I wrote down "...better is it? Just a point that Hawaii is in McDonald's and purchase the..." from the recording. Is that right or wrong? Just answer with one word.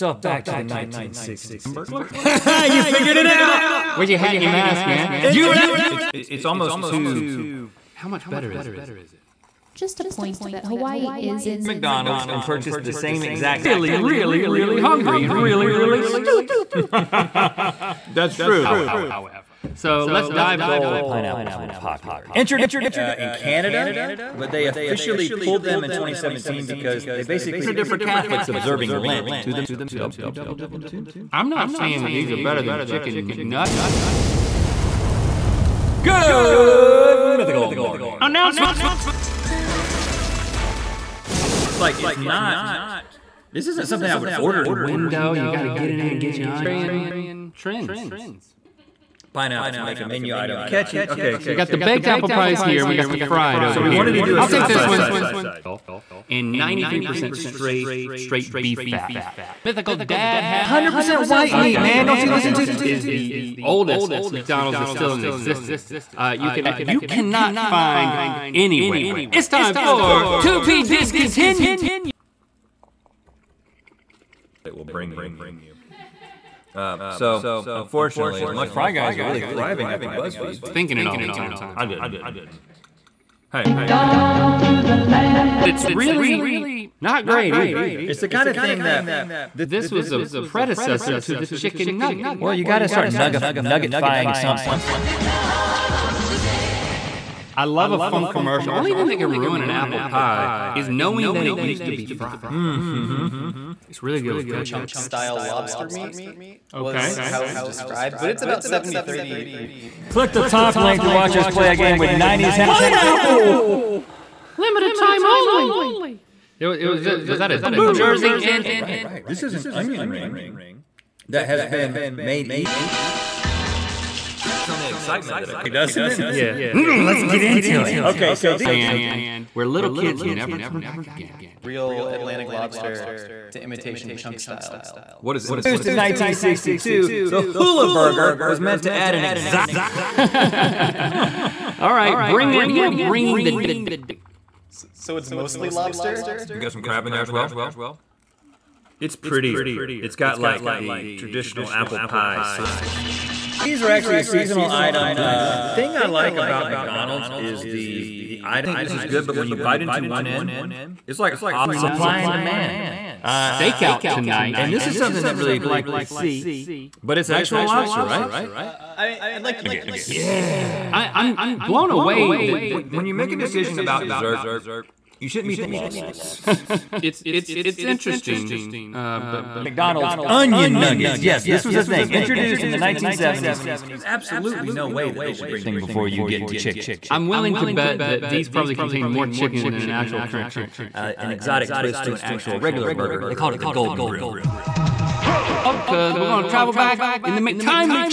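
right.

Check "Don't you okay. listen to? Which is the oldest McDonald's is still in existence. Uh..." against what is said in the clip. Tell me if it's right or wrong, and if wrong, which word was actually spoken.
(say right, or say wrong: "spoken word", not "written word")
right.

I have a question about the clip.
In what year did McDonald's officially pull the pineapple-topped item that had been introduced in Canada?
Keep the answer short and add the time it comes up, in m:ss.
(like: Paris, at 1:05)
2017, at 0:25.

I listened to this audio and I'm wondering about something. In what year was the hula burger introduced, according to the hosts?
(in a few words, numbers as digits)
1962.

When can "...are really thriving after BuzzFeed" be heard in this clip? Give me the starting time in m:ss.
1:19.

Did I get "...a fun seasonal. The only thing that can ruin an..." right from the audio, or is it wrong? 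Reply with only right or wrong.
wrong.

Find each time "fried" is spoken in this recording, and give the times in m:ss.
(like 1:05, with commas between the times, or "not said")
0:53, 1:42.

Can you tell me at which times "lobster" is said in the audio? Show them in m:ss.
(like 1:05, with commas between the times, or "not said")
1:45, 2:12, 2:25, 2:47.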